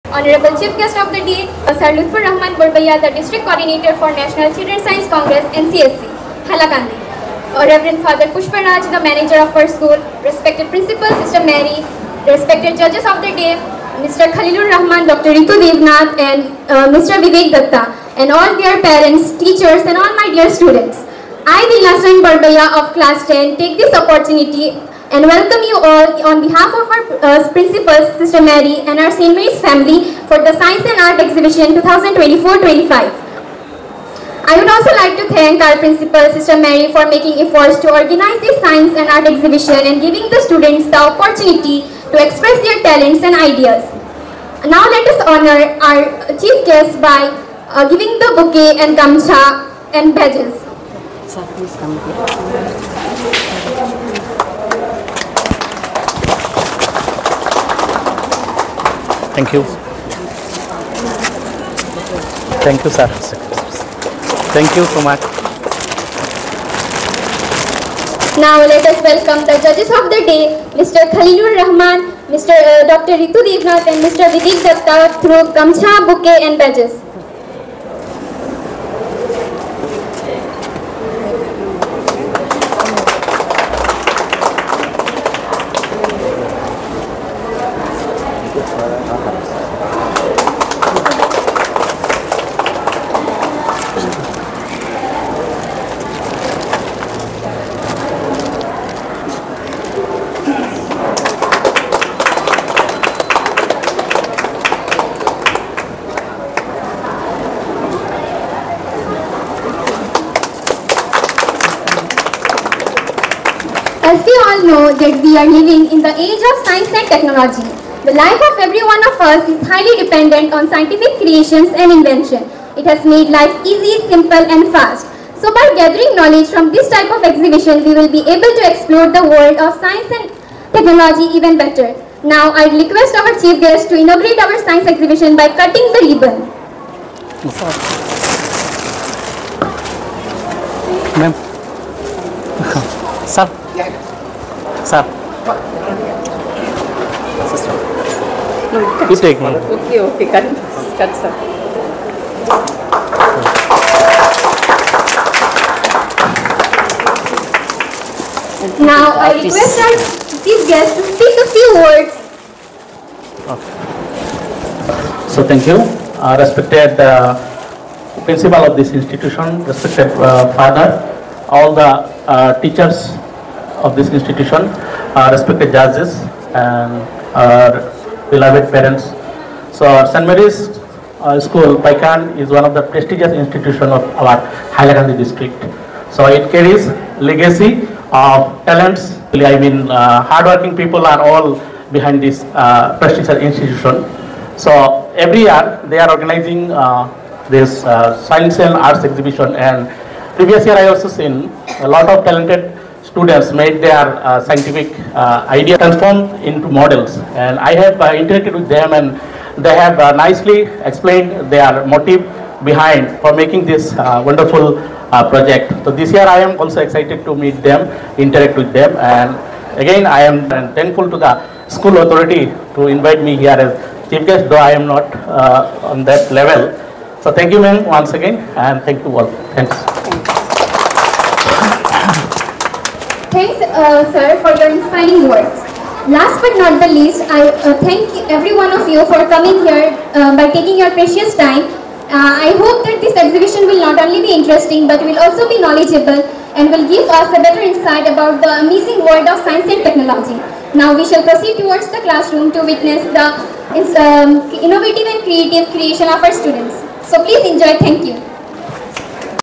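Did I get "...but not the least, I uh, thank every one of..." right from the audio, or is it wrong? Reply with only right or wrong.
right.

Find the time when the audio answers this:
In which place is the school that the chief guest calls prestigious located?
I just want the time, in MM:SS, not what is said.
03:01.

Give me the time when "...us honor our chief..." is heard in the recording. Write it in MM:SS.
00:45.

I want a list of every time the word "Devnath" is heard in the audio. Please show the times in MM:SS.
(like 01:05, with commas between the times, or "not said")
00:15, 01:13.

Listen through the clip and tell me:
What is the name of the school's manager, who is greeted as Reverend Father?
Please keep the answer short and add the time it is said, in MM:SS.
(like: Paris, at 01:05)
Pushparaj, at 00:08.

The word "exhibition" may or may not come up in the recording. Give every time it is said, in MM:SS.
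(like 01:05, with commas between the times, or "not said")
00:31, 00:39, 02:07, 02:14, 03:19, 04:03.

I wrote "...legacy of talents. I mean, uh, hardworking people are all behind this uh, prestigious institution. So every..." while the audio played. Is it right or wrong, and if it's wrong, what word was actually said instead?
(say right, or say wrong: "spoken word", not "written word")
right.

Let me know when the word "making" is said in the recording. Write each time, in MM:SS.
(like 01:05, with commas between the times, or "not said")
00:37, 03:33.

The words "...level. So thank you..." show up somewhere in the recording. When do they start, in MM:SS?
03:46.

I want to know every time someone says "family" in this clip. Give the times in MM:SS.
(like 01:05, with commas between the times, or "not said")
00:29.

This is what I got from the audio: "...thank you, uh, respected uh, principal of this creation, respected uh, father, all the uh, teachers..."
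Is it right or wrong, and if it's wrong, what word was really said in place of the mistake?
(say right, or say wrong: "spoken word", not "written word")
wrong: "institution", not "creation".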